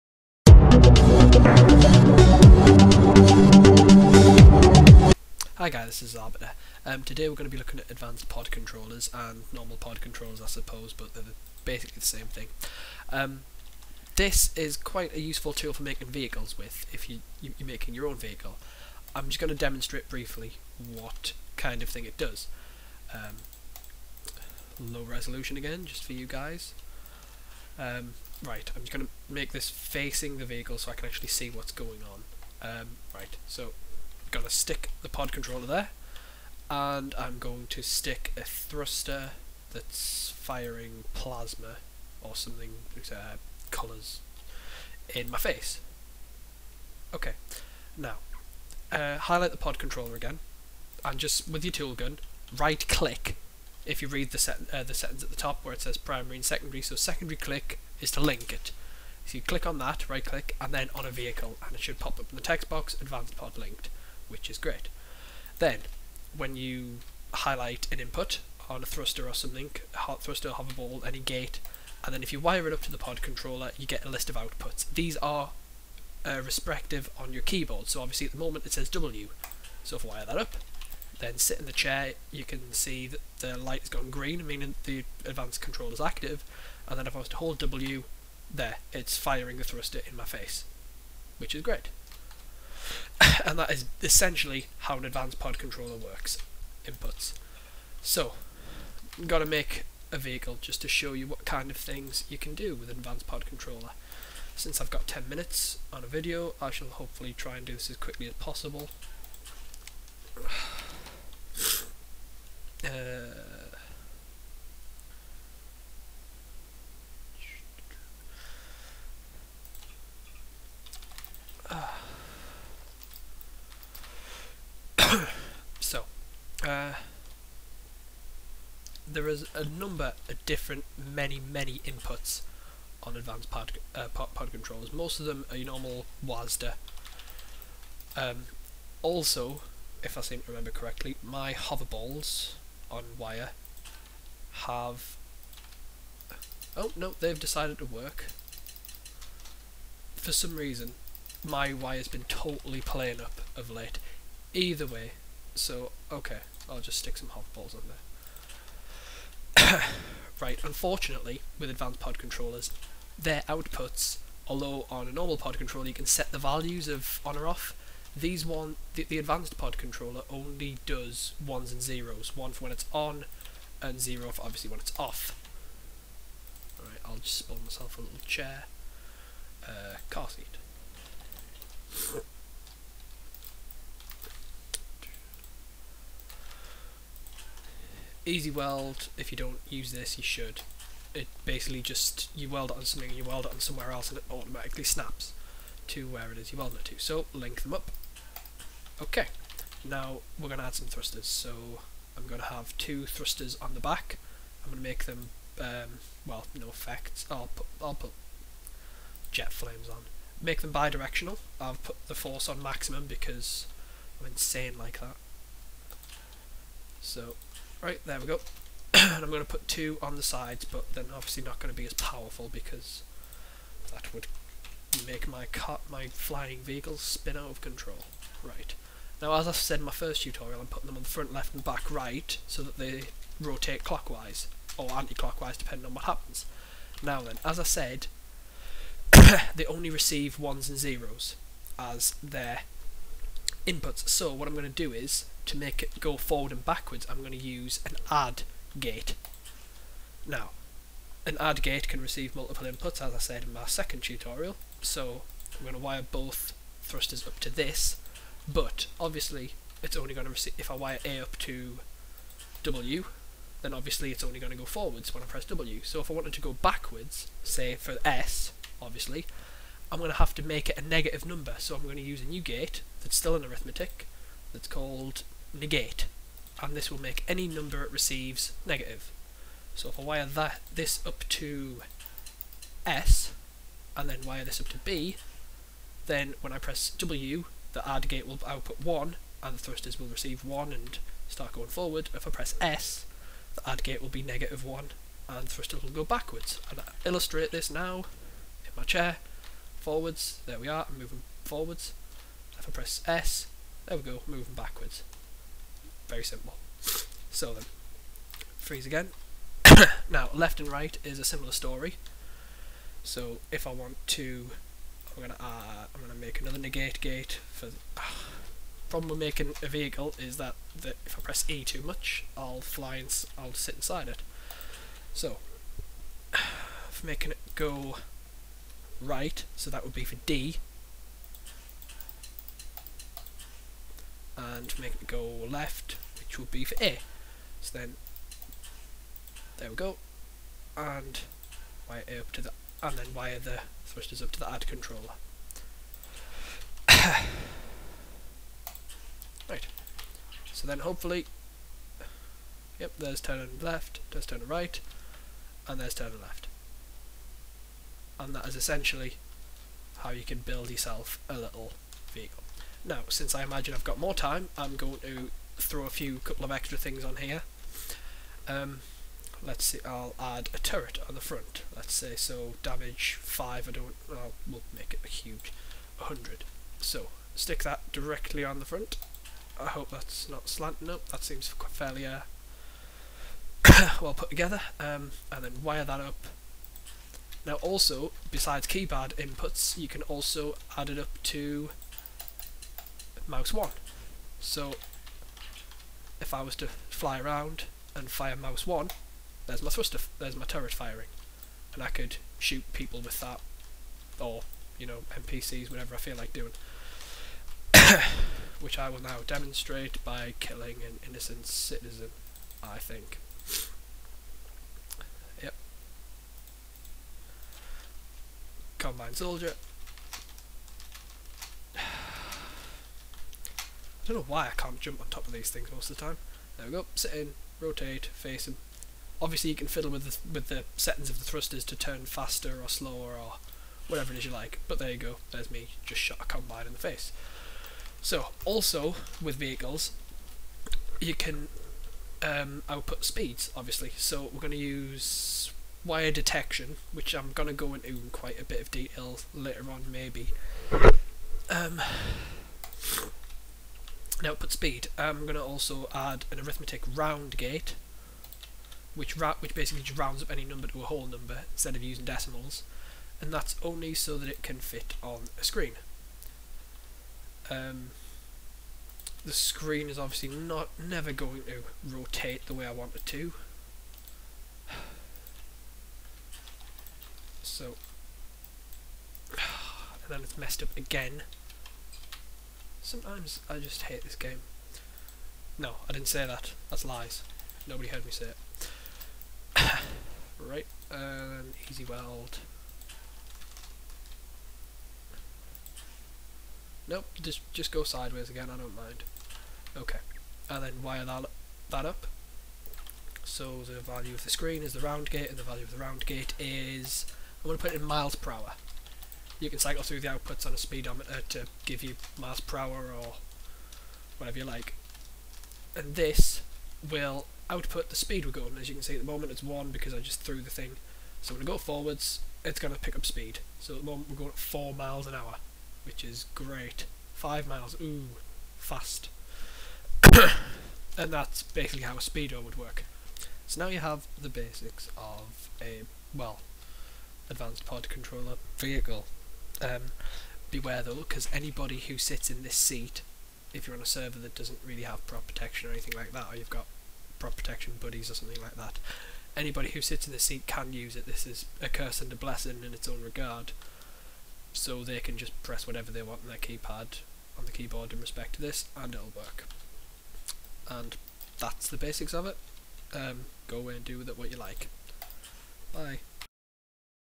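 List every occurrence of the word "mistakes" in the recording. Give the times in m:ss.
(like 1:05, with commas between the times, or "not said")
not said.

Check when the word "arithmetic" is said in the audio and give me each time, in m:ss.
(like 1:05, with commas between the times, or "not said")
4:33, 7:36.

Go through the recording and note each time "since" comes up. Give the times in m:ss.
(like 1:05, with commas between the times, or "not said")
1:44, 6:03.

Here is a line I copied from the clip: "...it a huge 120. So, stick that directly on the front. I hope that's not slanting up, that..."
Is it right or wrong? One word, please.
wrong.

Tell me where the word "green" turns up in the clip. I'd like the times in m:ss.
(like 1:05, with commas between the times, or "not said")
1:24.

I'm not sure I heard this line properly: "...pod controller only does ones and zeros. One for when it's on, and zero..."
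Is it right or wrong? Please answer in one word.
right.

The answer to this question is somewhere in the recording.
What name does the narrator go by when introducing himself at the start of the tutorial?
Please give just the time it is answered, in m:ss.
0:06.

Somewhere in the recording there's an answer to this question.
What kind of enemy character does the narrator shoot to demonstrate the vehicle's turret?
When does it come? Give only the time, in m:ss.
6:58.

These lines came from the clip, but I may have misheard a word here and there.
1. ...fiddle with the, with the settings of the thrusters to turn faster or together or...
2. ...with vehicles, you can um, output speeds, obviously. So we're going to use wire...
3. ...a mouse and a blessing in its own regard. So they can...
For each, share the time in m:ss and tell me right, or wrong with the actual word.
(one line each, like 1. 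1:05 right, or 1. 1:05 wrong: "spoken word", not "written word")
1. 7:09 wrong: "slower", not "together"
2. 7:19 right
3. 9:11 wrong: "curse", not "mouse".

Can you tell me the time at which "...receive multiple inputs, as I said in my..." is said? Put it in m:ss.
4:12.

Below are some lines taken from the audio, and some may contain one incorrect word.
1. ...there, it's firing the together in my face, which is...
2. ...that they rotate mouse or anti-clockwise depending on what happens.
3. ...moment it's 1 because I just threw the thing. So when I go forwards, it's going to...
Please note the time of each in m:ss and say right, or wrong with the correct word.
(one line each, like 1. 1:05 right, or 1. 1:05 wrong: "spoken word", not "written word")
1. 1:28 wrong: "thruster", not "together"
2. 3:52 wrong: "clockwise", not "mouse"
3. 8:39 right.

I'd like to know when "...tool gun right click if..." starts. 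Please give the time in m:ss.
0:51.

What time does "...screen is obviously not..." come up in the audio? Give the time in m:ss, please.
7:49.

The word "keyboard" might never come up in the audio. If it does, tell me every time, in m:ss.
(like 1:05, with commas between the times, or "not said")
1:17, 9:17.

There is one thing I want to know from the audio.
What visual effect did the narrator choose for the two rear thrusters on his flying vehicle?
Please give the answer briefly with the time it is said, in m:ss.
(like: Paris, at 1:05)
jet flames, at 3:29.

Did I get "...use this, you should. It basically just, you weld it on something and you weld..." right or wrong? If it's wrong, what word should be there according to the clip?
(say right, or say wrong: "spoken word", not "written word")
right.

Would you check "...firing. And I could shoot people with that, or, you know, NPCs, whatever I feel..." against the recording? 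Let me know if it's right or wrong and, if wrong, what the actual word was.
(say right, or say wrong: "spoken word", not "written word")
right.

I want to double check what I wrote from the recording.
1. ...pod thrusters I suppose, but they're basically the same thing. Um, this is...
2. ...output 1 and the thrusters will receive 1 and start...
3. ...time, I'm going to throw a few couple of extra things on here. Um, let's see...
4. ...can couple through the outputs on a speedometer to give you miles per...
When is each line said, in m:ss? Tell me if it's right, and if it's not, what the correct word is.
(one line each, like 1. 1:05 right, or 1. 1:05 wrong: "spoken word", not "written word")
1. 0:09 wrong: "controllers", not "thrusters"
2. 4:48 right
3. 6:04 right
4. 8:29 wrong: "cycle", not "couple".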